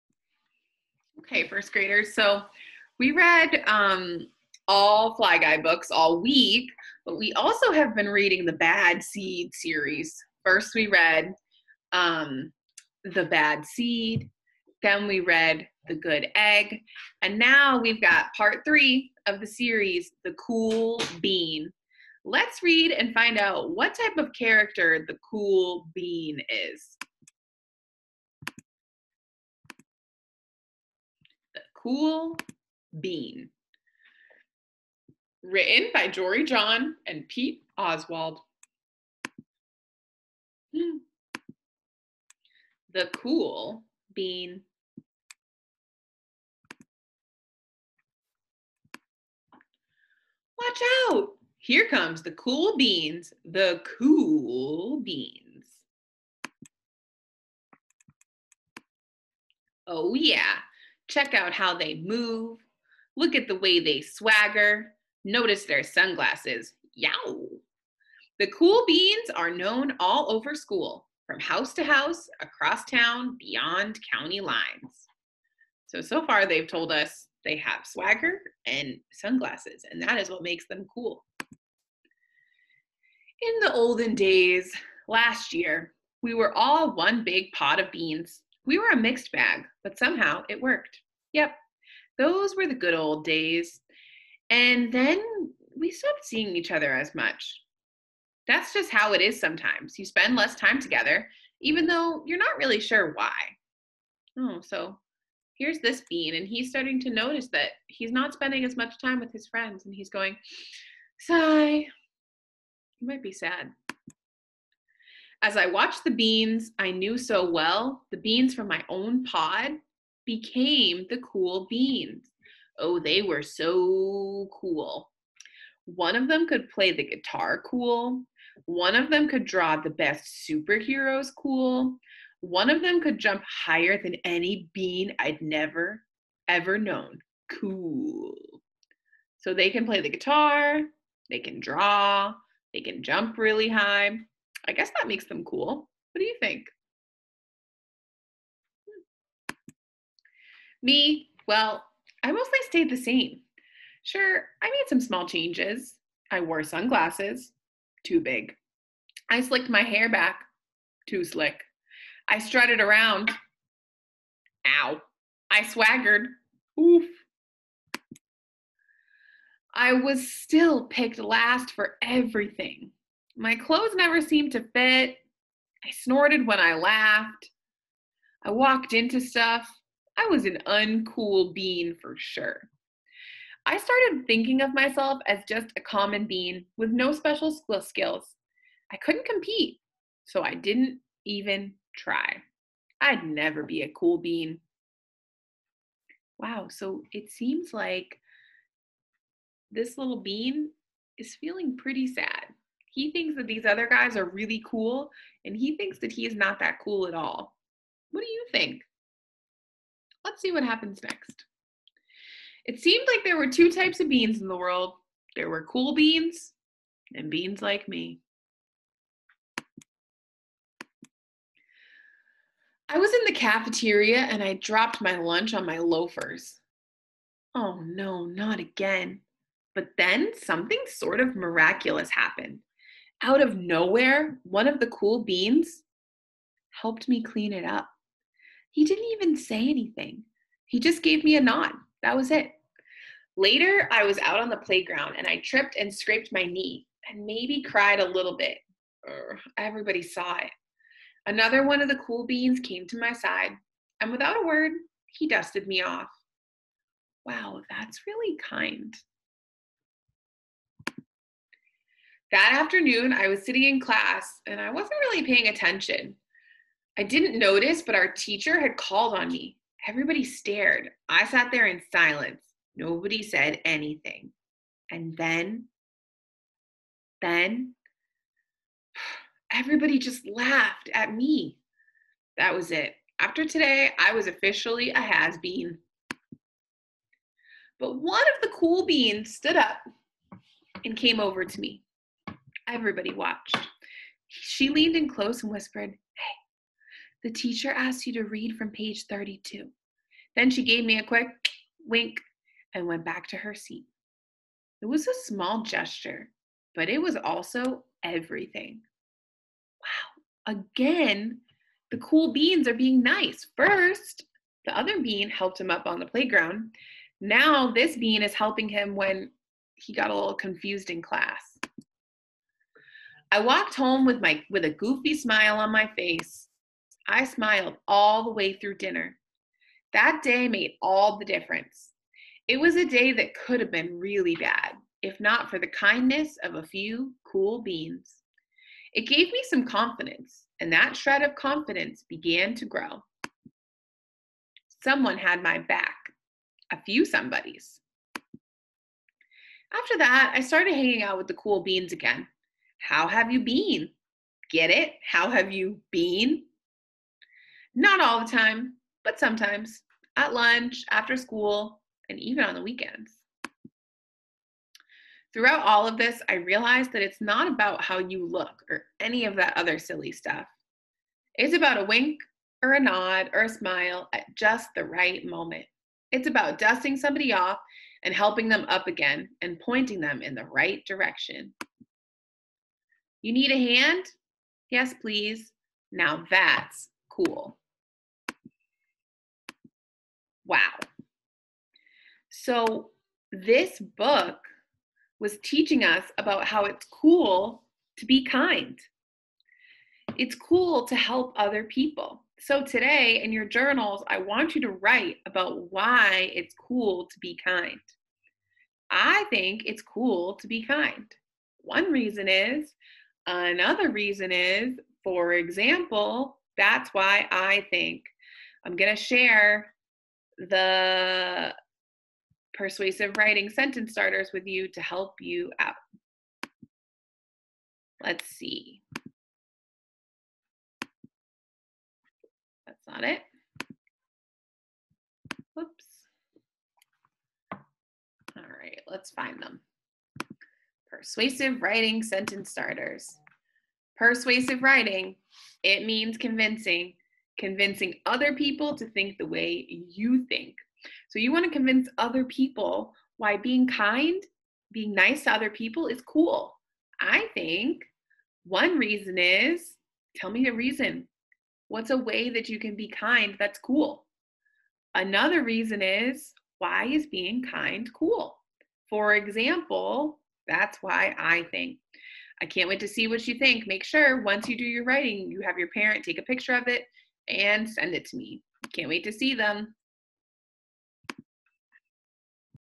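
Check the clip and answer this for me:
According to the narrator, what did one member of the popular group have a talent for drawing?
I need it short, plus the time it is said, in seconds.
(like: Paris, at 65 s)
superheroes, at 130 s.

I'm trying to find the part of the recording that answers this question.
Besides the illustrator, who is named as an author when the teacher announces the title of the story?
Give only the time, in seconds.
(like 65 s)
36 s.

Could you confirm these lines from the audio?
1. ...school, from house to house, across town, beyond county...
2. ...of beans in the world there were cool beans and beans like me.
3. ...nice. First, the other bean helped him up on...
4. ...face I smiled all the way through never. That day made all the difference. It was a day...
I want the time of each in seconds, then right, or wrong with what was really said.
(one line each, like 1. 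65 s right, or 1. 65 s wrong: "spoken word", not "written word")
1. 70 s right
2. 213 s right
3. 313 s right
4. 325 s wrong: "dinner", not "never".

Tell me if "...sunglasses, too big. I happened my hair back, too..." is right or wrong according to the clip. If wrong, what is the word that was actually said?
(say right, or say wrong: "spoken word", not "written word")
wrong: "slicked", not "happened".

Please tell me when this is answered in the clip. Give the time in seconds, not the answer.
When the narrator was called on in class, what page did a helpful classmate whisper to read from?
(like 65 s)
299 s.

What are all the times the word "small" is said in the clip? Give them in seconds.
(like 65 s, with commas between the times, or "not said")
155 s, 305 s.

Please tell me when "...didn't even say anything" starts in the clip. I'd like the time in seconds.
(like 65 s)
238 s.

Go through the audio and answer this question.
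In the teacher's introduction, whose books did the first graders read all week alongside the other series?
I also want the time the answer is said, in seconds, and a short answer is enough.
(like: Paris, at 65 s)
Fly Guy, at 5 s.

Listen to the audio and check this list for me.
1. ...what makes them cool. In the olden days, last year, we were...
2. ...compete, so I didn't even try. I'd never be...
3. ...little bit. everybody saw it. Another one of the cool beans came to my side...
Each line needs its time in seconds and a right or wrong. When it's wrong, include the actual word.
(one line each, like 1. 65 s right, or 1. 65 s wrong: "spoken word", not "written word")
1. 80 s right
2. 189 s right
3. 248 s right.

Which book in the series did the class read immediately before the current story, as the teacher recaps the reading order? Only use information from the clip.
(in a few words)
The Good Egg.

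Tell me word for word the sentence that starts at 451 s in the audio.
So you want to convince other people why being kind, being nice to other people is cool.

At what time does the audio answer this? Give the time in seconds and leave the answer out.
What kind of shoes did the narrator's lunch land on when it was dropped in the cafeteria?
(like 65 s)
225 s.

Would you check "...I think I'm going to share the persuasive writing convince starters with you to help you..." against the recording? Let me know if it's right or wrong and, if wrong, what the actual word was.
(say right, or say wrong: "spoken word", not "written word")
wrong: "sentence", not "convince".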